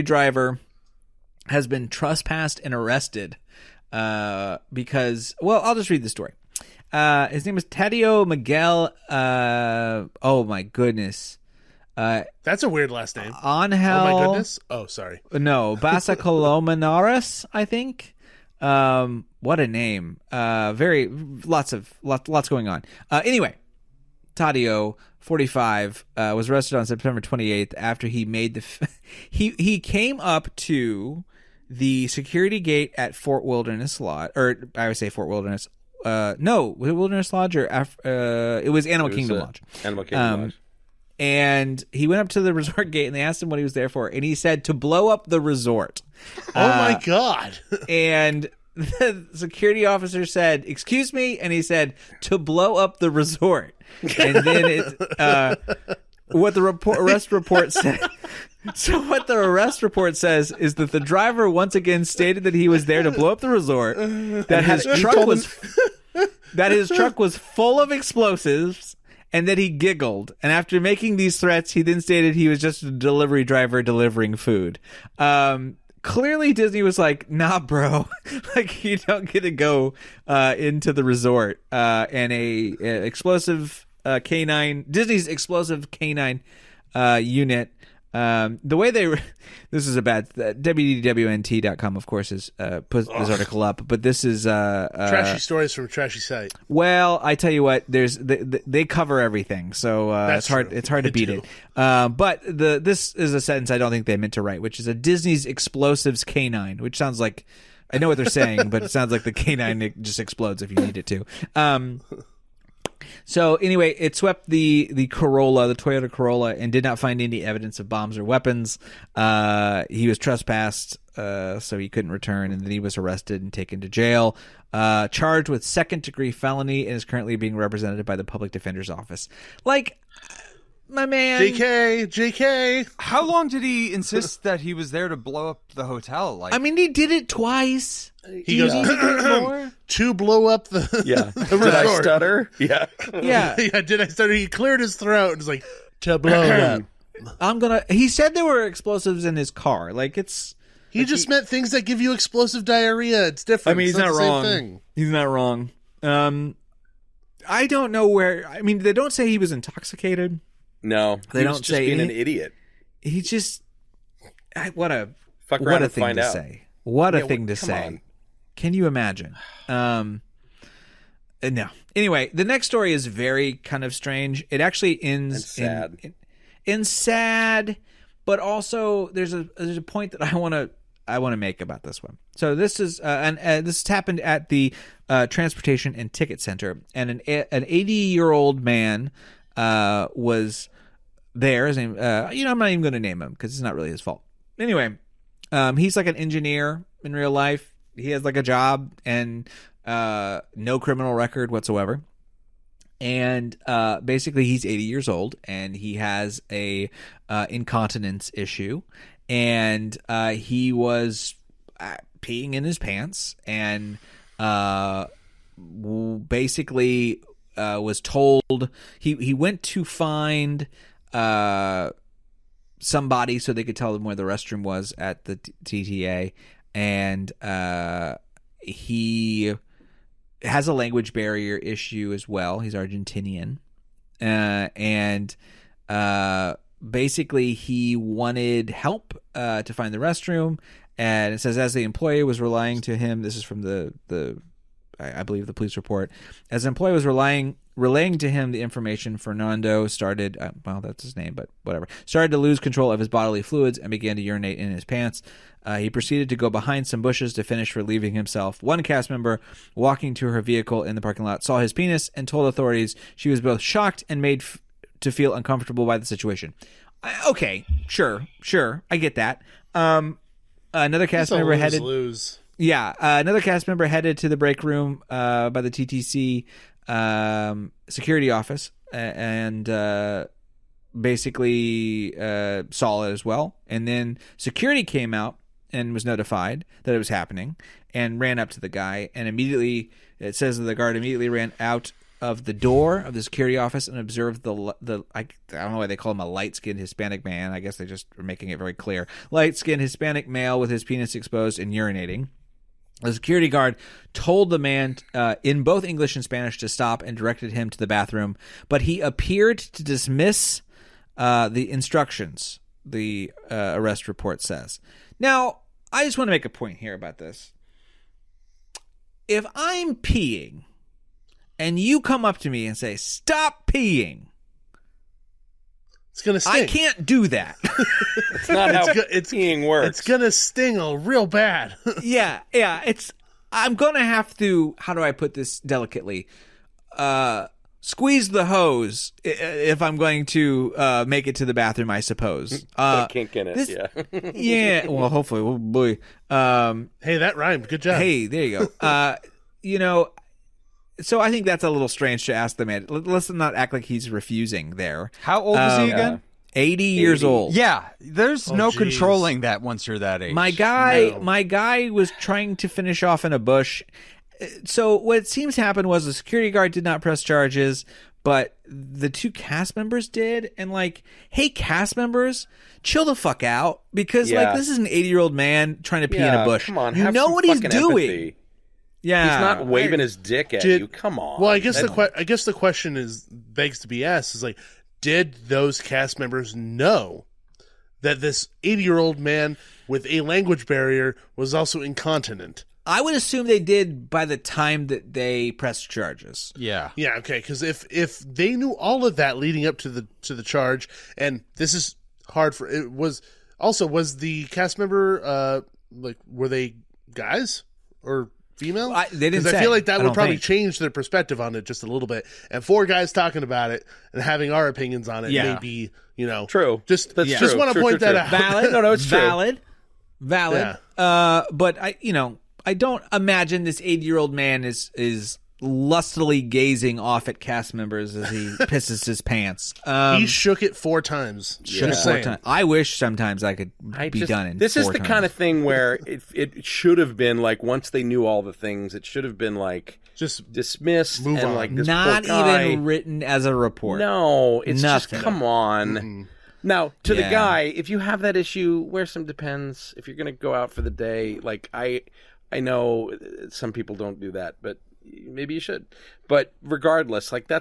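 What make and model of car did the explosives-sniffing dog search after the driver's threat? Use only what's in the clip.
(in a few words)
Toyota Corolla.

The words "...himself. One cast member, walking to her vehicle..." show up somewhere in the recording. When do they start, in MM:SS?
04:18.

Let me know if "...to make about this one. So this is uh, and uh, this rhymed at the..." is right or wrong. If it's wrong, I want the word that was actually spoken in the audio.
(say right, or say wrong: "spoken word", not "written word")
wrong: "happened", not "rhymed".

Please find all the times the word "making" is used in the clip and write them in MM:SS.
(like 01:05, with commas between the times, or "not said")
01:10, 04:58.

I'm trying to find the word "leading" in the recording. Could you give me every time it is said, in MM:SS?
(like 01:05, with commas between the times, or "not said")
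06:39.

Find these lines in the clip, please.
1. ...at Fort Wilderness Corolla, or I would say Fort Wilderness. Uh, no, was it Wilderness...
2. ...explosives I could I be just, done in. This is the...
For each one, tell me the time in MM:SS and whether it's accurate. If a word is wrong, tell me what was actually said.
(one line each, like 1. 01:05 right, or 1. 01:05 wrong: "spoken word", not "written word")
1. 00:32 wrong: "Lodge", not "Corolla"
2. 07:12 wrong: "sometimes", not "explosives".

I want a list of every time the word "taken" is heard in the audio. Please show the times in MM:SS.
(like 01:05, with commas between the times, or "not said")
02:03.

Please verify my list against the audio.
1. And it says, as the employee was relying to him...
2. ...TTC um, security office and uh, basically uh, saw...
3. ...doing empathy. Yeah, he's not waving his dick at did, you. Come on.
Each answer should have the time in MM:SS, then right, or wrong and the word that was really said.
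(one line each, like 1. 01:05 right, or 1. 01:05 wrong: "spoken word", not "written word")
1. 04:00 right
2. 04:35 right
3. 06:17 right.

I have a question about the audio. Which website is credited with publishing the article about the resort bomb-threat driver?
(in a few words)
WDWNT.com.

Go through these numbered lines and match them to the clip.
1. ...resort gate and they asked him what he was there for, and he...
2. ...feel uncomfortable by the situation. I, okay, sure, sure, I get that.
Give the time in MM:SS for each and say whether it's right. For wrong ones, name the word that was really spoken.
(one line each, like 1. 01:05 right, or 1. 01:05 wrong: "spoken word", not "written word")
1. 00:42 right
2. 04:25 right.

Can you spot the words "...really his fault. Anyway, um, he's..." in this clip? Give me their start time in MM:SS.
03:13.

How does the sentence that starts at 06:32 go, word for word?
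I would assume they did by the time that they pressed charges.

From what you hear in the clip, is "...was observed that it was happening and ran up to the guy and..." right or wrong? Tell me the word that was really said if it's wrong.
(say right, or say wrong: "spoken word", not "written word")
wrong: "notified", not "observed".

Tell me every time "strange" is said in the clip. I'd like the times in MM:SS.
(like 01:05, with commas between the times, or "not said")
02:53, 05:51.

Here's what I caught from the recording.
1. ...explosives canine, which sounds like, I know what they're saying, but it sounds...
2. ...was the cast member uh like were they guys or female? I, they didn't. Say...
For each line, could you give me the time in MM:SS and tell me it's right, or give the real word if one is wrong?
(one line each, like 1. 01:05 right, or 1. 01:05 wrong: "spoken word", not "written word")
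1. 01:45 right
2. 06:43 right.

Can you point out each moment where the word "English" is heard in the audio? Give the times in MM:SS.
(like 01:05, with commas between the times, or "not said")
05:05.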